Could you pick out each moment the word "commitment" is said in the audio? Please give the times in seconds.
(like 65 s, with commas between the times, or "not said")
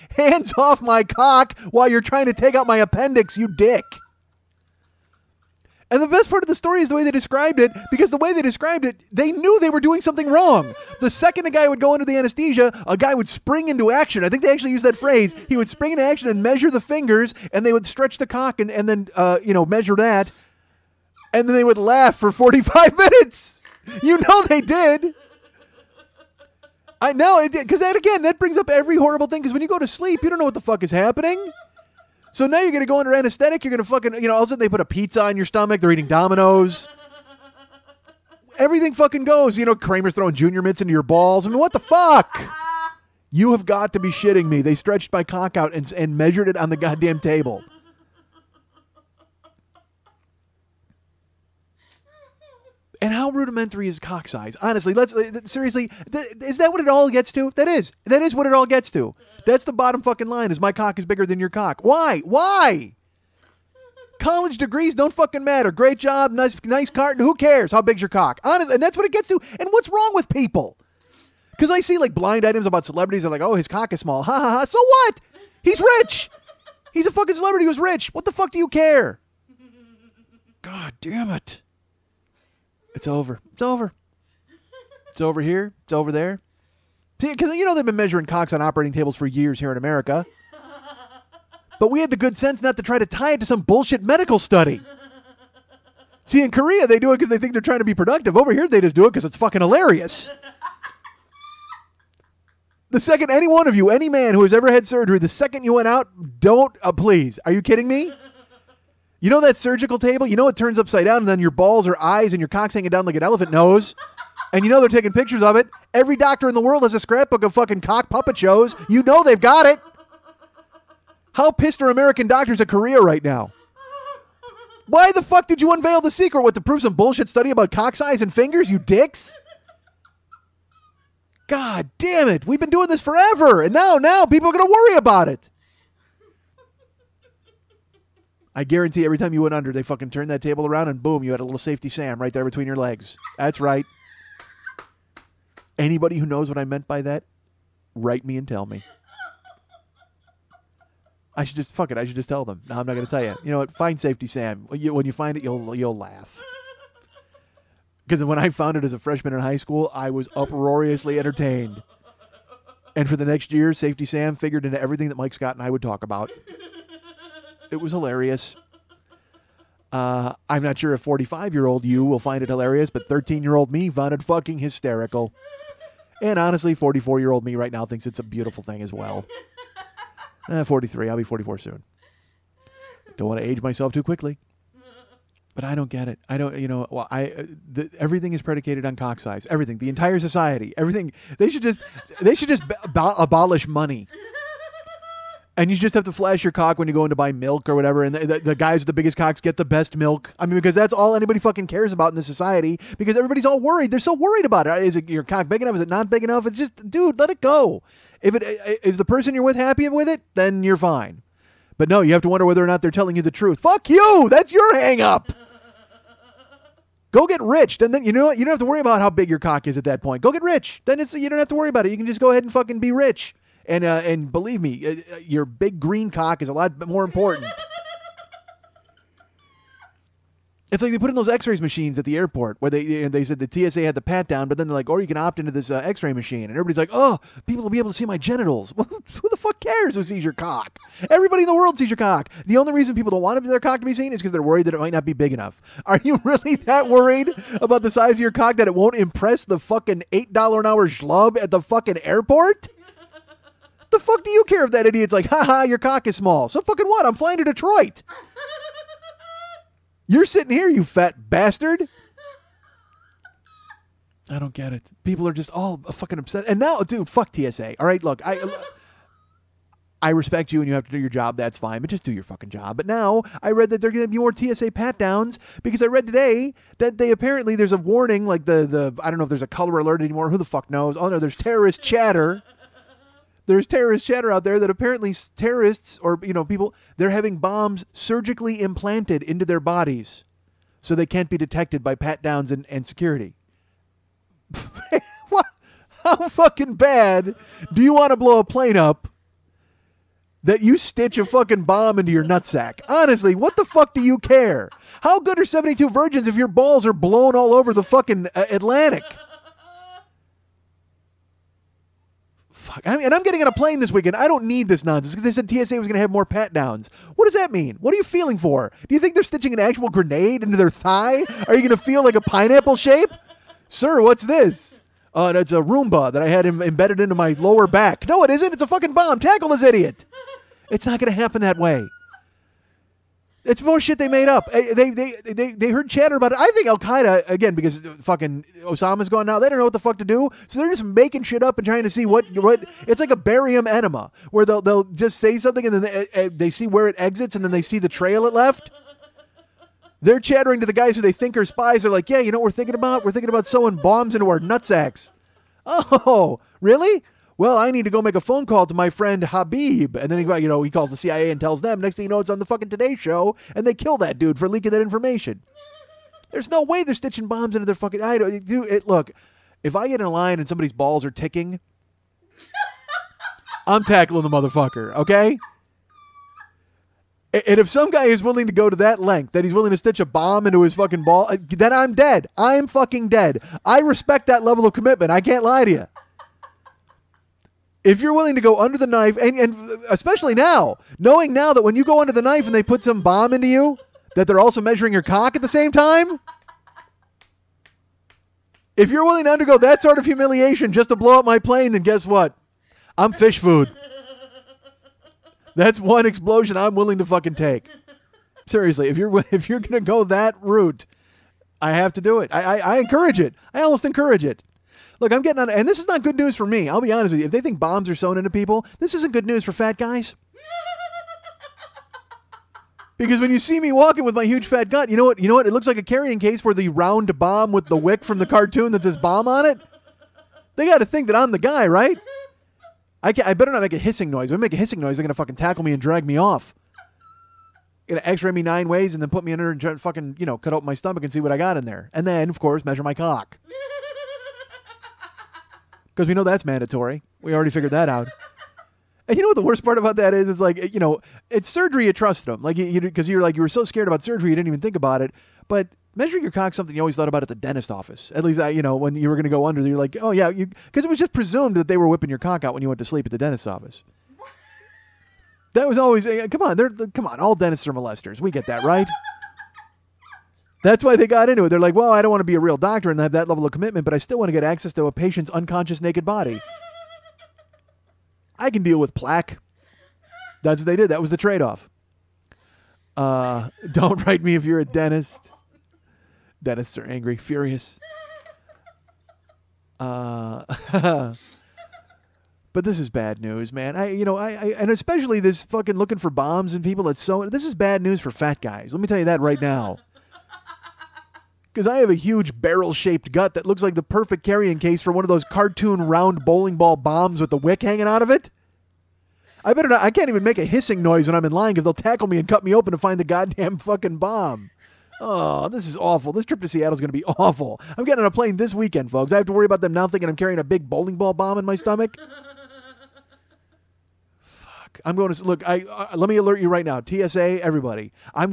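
384 s, 473 s.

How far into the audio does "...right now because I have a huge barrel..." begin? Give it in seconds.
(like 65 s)
499 s.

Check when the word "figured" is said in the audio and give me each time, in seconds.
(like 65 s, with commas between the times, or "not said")
164 s, 447 s.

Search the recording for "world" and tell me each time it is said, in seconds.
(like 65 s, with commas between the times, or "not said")
116 s, 241 s.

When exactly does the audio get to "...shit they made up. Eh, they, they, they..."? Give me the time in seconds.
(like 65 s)
333 s.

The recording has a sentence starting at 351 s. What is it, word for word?
They're like, yeah, you know what we're thinking about?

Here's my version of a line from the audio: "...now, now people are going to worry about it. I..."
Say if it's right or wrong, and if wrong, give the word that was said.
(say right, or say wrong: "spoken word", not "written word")
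right.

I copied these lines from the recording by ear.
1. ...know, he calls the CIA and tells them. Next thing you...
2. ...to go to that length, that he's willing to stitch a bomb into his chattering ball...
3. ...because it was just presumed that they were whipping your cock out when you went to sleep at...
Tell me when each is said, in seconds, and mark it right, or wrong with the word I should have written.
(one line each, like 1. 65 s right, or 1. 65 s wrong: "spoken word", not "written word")
1. 360 s right
2. 378 s wrong: "fucking", not "chattering"
3. 460 s right.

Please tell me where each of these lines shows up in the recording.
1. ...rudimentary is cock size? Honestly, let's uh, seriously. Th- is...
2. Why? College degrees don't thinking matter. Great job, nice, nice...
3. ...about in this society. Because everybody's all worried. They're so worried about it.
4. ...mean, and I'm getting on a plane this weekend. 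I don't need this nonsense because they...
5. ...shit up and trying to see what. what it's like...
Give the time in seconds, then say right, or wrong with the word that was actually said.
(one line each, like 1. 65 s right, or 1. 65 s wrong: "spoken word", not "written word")
1. 53 s right
2. 62 s wrong: "fucking", not "thinking"
3. 201 s right
4. 312 s right
5. 341 s right.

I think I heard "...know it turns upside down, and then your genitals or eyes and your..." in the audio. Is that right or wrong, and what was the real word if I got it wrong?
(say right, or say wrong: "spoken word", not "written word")
wrong: "balls", not "genitals".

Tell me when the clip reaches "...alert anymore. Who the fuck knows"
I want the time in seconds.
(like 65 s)
279 s.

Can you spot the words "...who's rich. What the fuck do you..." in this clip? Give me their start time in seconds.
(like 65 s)
77 s.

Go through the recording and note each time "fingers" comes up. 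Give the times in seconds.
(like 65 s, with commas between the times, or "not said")
16 s, 128 s.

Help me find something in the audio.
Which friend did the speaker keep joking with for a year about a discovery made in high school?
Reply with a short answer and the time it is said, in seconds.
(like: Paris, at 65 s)
Mike Scott, at 165 s.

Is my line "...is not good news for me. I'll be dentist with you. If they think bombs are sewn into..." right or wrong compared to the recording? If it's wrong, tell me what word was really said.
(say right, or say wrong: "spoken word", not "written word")
wrong: "honest", not "dentist".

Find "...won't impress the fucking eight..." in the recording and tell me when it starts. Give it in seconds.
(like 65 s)
248 s.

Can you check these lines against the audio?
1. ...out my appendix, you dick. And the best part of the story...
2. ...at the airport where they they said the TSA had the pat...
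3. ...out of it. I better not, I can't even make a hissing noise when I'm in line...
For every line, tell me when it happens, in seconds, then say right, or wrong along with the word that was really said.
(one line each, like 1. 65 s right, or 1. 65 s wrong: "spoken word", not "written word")
1. 2 s right
2. 231 s right
3. 507 s right.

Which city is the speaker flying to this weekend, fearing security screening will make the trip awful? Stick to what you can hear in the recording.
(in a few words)
Seattle.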